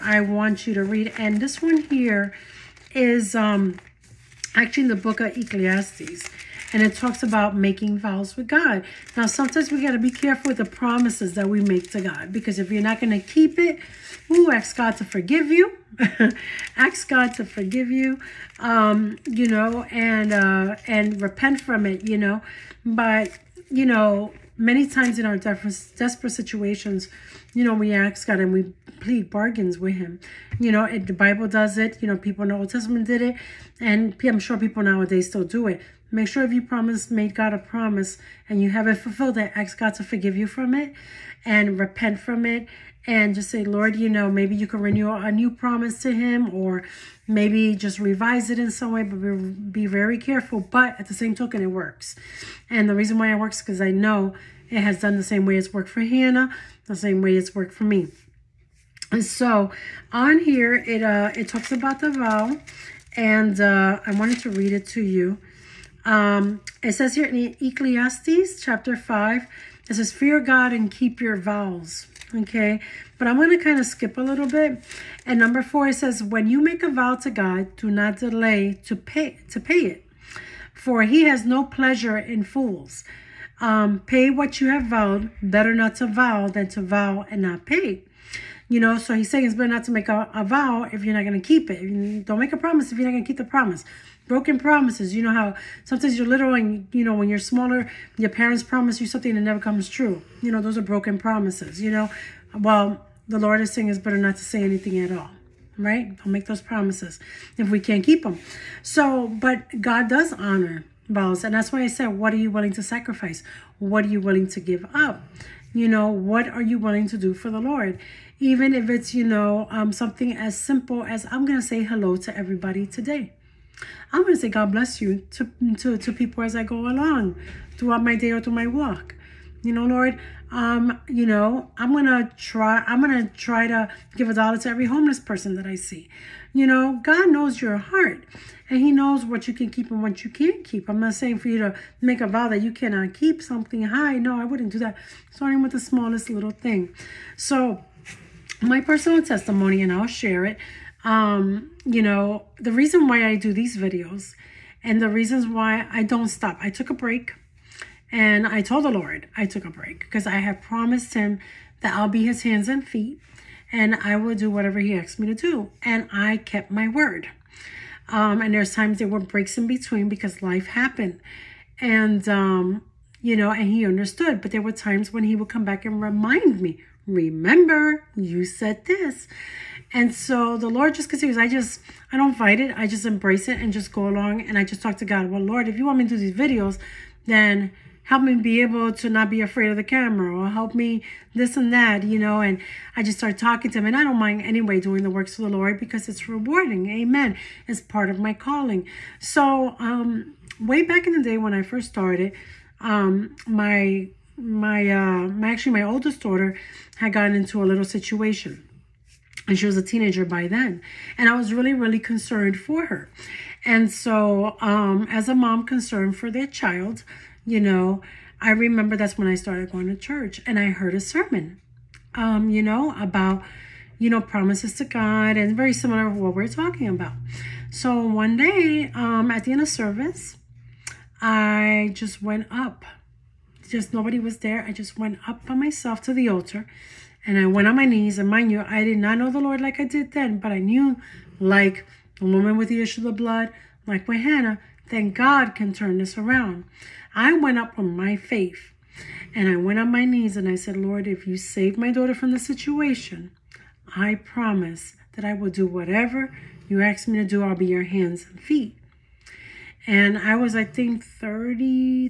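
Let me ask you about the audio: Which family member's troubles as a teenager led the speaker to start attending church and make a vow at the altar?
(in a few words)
Oldest daughter.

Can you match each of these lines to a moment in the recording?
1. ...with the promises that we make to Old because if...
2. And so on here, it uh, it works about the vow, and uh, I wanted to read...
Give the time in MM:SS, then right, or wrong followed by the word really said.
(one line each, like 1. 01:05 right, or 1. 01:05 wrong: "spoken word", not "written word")
1. 00:10 wrong: "God", not "Old"
2. 00:59 wrong: "talks", not "works".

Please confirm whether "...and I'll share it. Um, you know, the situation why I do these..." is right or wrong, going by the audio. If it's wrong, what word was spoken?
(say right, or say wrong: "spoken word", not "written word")
wrong: "reason", not "situation".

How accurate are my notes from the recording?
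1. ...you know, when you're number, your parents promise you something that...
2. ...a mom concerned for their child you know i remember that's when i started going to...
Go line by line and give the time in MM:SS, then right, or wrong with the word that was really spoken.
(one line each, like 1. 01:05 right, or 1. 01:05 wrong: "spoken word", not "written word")
1. 01:36 wrong: "smaller", not "number"
2. 03:35 right.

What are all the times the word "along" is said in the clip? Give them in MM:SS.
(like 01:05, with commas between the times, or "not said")
02:06, 03:04.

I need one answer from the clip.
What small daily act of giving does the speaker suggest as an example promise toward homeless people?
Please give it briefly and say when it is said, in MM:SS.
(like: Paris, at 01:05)
Give a dollar, at 02:14.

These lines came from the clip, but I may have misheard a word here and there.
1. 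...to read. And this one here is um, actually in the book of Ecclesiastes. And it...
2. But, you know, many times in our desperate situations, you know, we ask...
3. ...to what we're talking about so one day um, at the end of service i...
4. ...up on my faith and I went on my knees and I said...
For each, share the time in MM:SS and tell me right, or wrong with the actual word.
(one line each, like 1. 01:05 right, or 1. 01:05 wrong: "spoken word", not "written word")
1. 00:00 right
2. 00:22 right
3. 03:46 right
4. 04:07 right.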